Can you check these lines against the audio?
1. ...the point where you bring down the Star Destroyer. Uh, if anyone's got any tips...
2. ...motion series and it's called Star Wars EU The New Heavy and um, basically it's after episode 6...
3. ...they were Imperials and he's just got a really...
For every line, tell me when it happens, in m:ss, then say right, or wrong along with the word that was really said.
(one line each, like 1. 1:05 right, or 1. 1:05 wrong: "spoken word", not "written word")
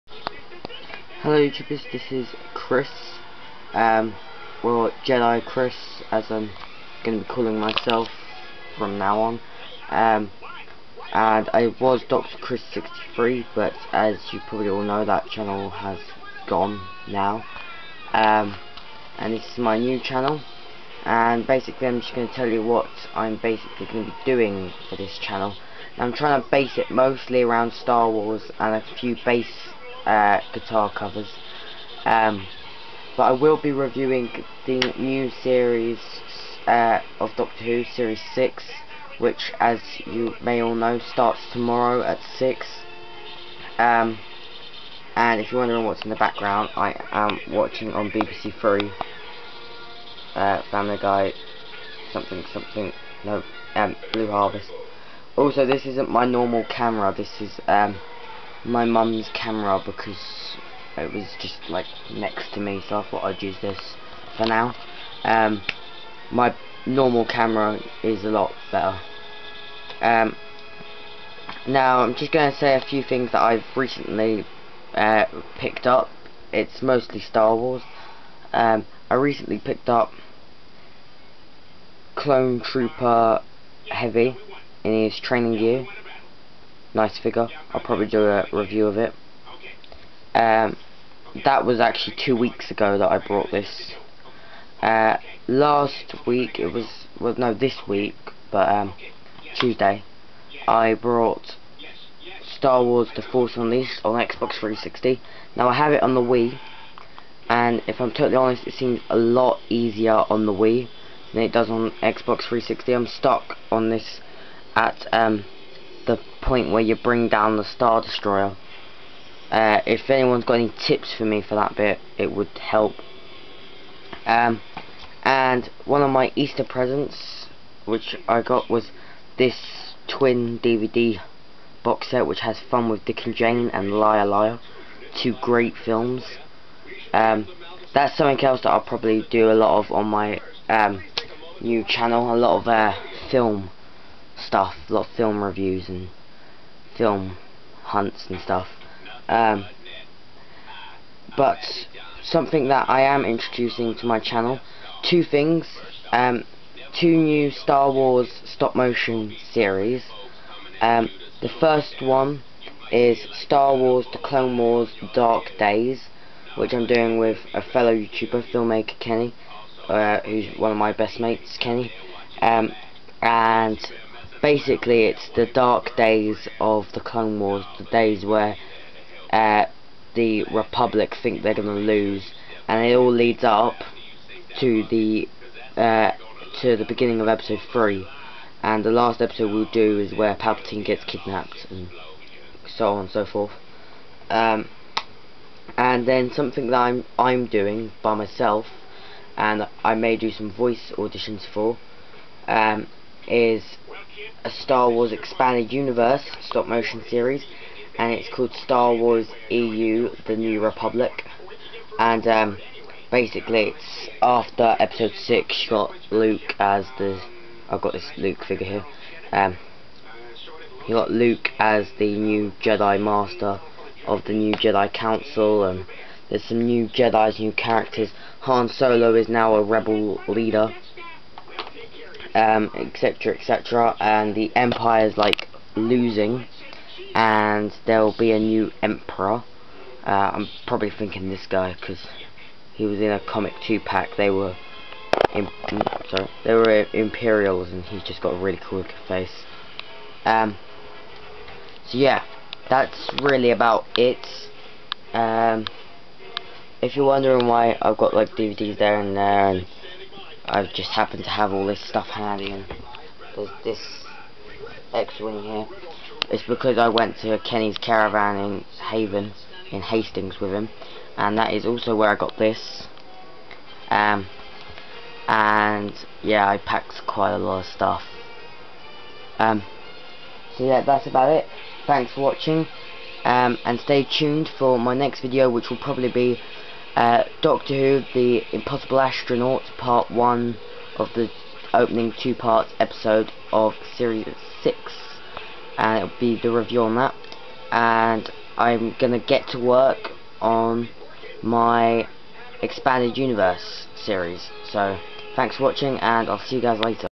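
1. 1:56 right
2. 3:26 wrong: "Republic", not "Heavy"
3. 4:06 right.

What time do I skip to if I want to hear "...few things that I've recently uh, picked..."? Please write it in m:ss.
1:12.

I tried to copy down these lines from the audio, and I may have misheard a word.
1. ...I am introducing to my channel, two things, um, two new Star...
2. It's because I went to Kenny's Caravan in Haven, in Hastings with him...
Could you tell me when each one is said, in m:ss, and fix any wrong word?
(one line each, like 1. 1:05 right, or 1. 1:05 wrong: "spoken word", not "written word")
1. 2:32 right
2. 4:26 right.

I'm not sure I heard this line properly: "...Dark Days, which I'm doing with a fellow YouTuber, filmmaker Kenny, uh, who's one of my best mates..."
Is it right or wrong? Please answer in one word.
right.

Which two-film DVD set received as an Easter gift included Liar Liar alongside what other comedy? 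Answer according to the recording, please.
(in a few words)
Fun with Dick and Jane.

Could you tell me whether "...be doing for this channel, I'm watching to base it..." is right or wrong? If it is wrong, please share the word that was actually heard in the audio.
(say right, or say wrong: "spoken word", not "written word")
wrong: "trying", not "watching".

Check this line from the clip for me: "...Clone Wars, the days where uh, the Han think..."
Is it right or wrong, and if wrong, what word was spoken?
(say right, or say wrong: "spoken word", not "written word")
wrong: "Republic", not "Han".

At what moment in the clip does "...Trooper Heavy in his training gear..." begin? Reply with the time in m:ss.
1:22.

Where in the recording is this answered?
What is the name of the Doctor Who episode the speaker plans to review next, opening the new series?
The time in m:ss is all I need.
4:48.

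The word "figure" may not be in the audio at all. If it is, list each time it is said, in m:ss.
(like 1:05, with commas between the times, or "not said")
1:27, 3:38.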